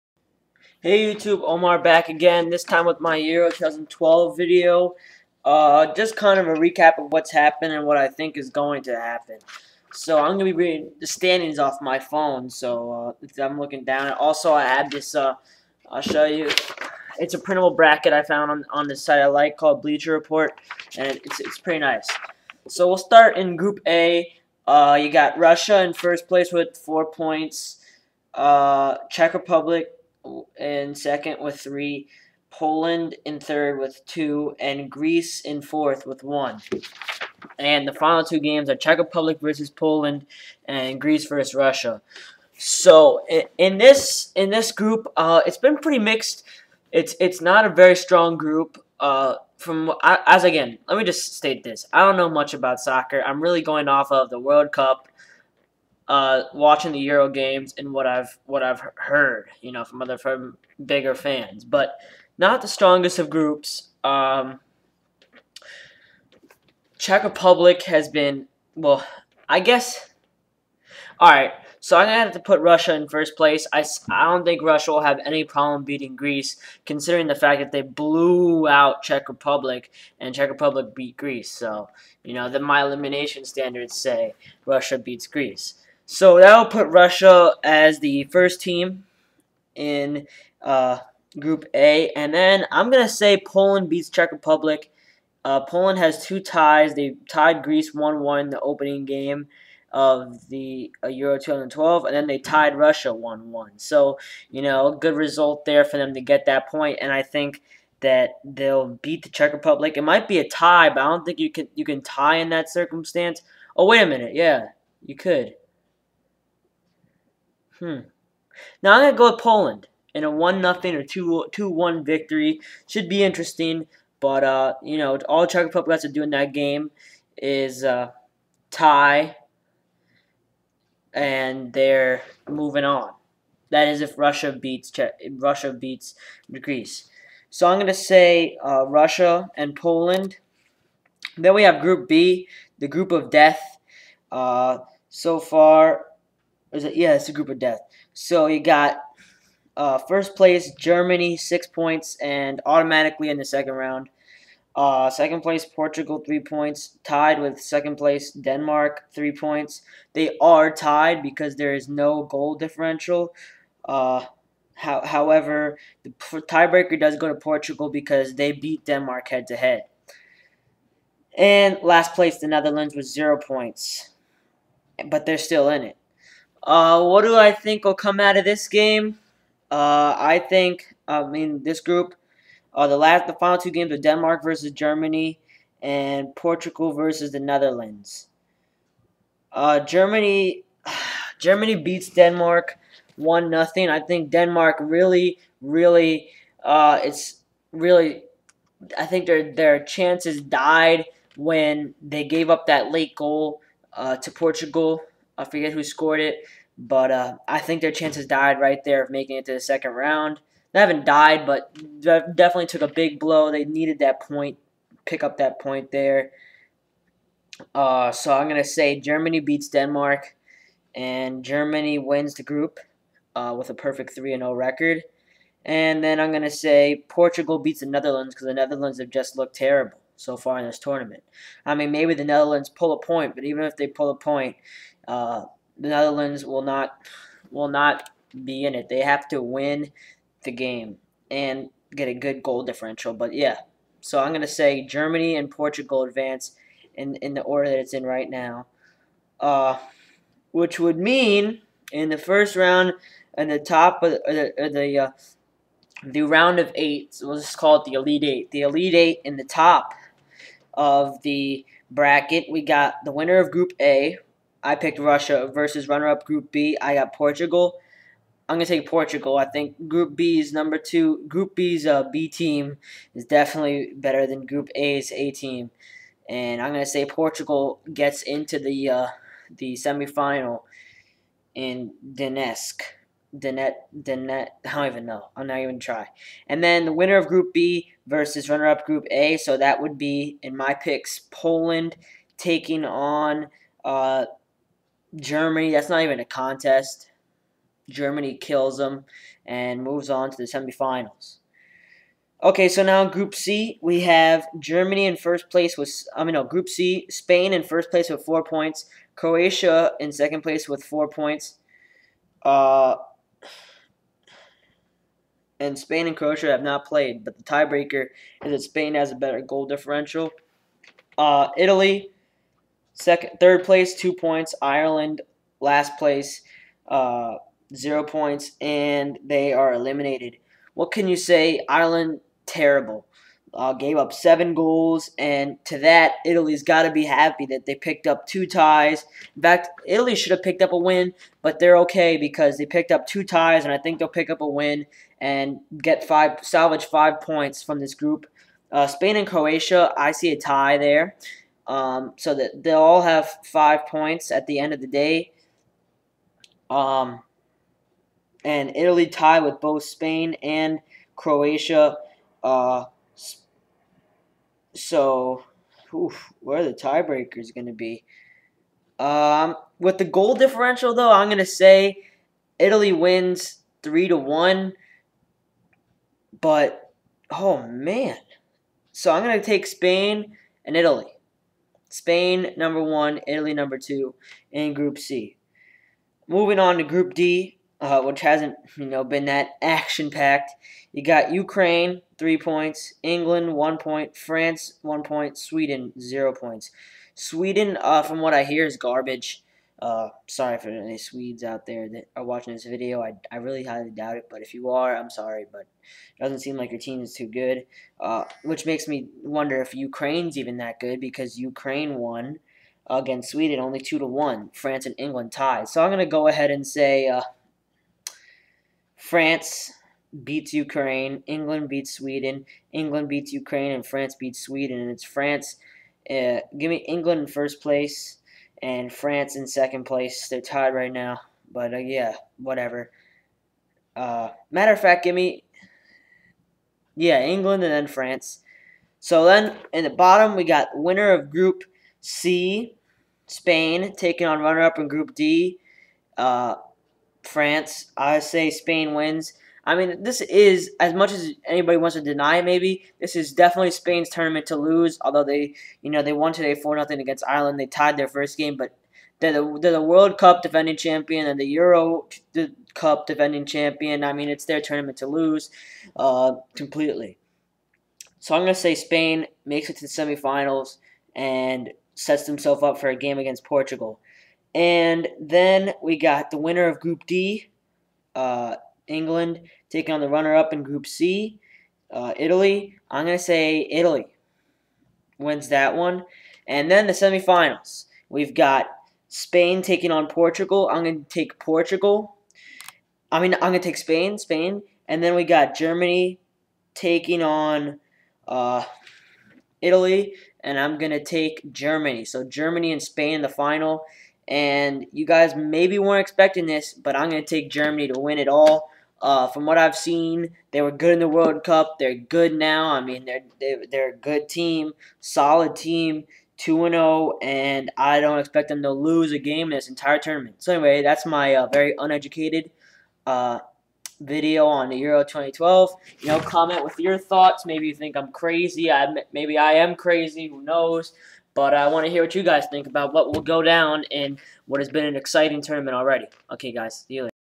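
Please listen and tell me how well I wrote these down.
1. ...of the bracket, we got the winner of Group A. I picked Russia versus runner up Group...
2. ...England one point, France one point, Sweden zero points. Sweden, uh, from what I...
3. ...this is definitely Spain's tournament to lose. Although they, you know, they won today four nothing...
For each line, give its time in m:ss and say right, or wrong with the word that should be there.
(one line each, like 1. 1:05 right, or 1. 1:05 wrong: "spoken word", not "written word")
1. 4:20 right
2. 6:33 right
3. 7:32 right.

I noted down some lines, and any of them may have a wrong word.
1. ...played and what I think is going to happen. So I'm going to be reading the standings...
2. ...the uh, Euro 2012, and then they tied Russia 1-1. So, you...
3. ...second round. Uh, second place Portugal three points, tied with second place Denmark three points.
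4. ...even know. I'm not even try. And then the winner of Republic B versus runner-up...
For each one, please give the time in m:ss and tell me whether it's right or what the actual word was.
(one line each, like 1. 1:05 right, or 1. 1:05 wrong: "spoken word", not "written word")
1. 0:07 wrong: "happened", not "played"
2. 1:40 right
3. 2:33 right
4. 4:44 wrong: "Group", not "Republic".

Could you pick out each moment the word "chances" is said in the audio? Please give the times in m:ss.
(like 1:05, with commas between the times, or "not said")
3:19, 3:27.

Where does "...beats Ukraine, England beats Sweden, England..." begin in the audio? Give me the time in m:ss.
7:00.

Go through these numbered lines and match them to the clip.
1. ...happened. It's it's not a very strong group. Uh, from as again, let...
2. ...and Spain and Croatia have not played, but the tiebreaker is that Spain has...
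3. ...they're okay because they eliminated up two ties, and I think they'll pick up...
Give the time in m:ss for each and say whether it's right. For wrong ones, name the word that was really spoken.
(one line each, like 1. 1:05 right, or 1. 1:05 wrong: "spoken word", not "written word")
1. 0:45 wrong: "mixed", not "happened"
2. 5:15 right
3. 5:41 wrong: "picked", not "eliminated".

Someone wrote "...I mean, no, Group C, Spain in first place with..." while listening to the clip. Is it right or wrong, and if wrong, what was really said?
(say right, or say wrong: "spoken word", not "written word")
right.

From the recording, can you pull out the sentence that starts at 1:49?
It might be a tie, but I don't think you can you can tie in that circumstance.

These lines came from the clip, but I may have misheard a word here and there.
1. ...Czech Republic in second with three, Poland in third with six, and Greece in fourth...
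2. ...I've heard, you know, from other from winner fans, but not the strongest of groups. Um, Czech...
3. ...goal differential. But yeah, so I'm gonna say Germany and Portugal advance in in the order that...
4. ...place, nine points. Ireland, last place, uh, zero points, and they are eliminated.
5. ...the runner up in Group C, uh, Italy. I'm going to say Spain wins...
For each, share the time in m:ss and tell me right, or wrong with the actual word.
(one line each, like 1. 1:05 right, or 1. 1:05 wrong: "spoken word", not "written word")
1. 0:29 wrong: "two", not "six"
2. 0:58 wrong: "bigger", not "winner"
3. 4:02 right
4. 5:23 wrong: "two", not "nine"
5. 8:00 wrong: "Italy", not "Spain".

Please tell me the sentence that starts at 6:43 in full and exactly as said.
I, I really highly doubt it, but if you are, I'm sorry, but it doesn't seem like your team is too good.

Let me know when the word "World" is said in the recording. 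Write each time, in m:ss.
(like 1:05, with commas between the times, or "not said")
0:54, 7:39, 8:31.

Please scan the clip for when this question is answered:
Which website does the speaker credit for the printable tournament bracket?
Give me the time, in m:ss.
0:19.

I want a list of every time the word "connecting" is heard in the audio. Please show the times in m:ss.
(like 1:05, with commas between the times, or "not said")
not said.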